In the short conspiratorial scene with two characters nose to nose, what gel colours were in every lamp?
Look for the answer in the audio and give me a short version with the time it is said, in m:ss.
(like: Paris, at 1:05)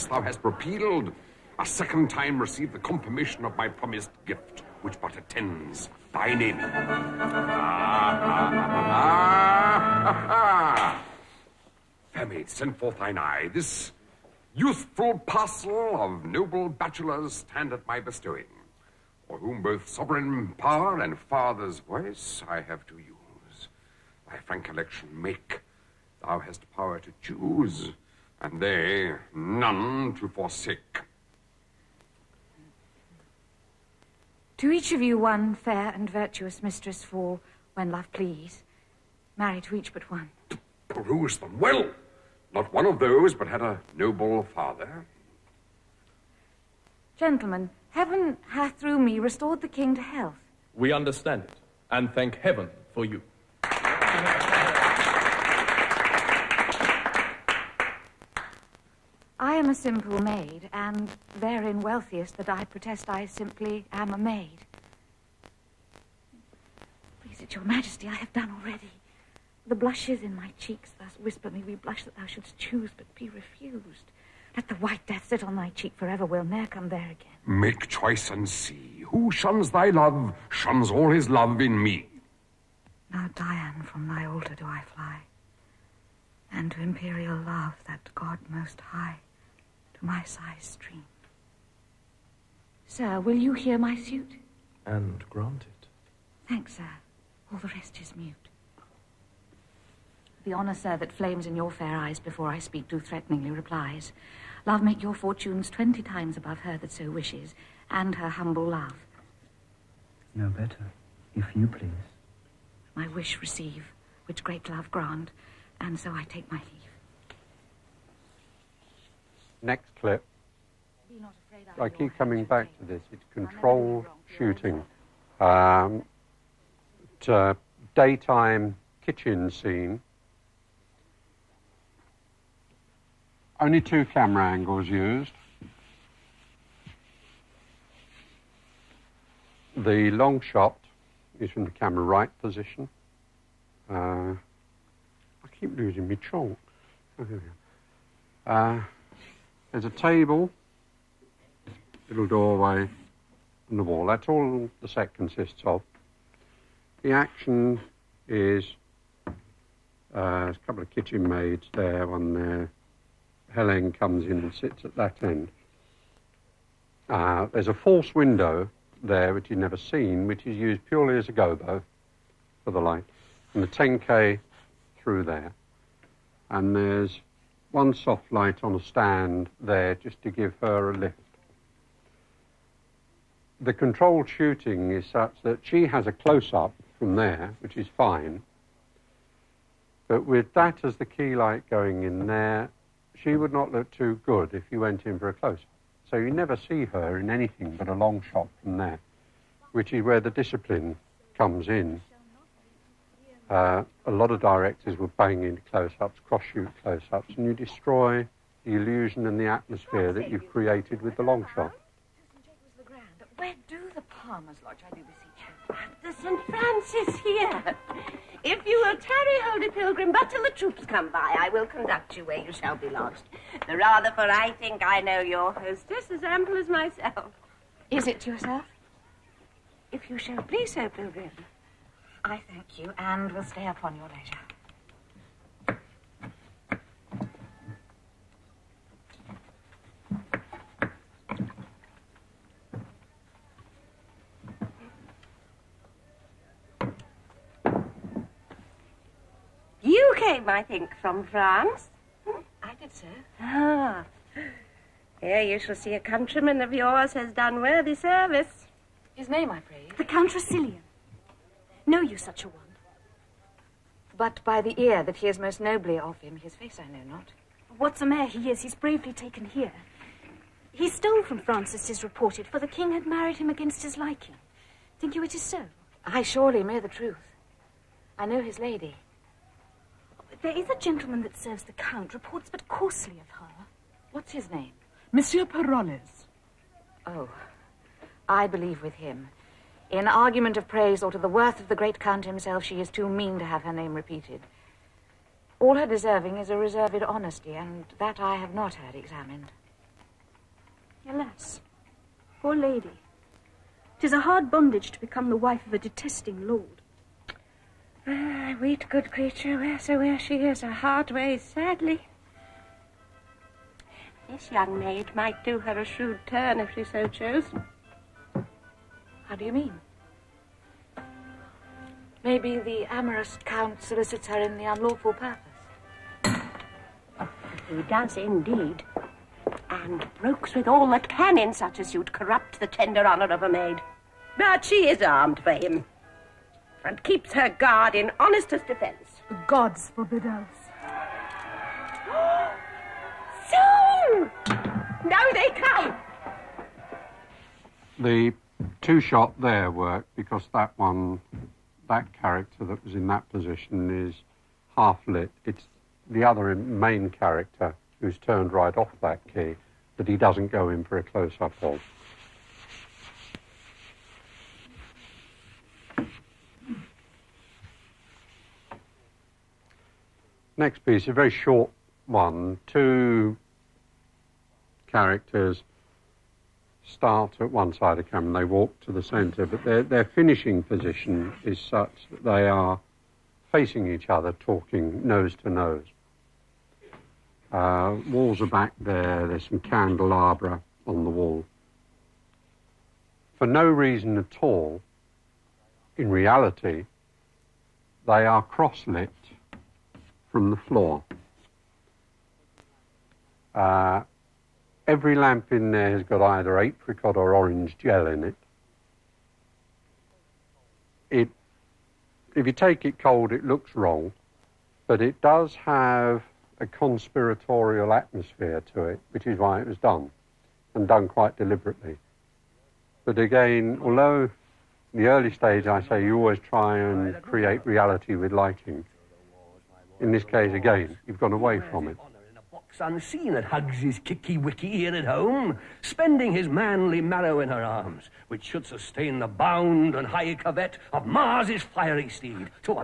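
Apricot or orange, at 6:46.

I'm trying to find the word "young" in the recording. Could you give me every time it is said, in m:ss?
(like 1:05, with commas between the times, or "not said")
5:14.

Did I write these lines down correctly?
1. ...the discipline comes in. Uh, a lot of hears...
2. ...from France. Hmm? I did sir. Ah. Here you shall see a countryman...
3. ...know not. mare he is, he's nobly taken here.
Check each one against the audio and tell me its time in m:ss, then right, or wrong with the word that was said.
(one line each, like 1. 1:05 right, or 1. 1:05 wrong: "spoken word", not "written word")
1. 3:20 wrong: "directors", not "hears"
2. 4:10 right
3. 4:26 wrong: "bravely", not "nobly".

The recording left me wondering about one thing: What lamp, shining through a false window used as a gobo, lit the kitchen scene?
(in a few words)
10k.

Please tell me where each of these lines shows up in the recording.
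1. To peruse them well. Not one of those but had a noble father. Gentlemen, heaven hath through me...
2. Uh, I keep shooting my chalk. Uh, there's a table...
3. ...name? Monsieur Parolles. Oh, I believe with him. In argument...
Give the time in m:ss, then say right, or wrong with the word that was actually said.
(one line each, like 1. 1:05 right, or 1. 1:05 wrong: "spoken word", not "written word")
1. 0:40 right
2. 2:23 wrong: "losing", not "shooting"
3. 4:44 right.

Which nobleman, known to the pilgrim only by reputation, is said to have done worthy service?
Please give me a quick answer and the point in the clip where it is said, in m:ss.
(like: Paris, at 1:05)
Count Rossillion, at 4:19.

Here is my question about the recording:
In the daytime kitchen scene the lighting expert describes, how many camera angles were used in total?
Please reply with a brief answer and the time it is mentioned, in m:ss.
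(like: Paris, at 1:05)
2, at 2:13.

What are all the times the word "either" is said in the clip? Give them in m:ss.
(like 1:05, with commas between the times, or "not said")
6:46.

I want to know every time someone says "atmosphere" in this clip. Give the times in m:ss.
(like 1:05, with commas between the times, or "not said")
3:29, 6:57.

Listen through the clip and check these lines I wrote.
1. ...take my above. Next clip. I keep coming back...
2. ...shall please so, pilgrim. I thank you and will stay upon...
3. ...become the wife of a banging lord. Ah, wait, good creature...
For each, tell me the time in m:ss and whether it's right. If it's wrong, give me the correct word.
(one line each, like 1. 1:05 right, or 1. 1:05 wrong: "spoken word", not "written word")
1. 1:56 wrong: "leave", not "above"
2. 3:50 right
3. 5:04 wrong: "detesting", not "banging".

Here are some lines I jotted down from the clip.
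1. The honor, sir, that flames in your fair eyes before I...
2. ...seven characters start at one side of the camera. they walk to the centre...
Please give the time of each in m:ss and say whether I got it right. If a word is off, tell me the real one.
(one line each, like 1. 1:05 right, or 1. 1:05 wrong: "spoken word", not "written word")
1. 1:40 right
2. 6:12 wrong: "two", not "seven".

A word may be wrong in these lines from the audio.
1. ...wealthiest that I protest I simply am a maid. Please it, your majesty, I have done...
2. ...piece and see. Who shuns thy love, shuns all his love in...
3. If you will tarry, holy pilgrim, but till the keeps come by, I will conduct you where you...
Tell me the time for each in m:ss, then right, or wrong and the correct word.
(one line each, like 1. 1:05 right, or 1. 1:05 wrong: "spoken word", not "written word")
1. 1:01 right
2. 1:17 wrong: "choice", not "piece"
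3. 3:38 wrong: "troops", not "keeps".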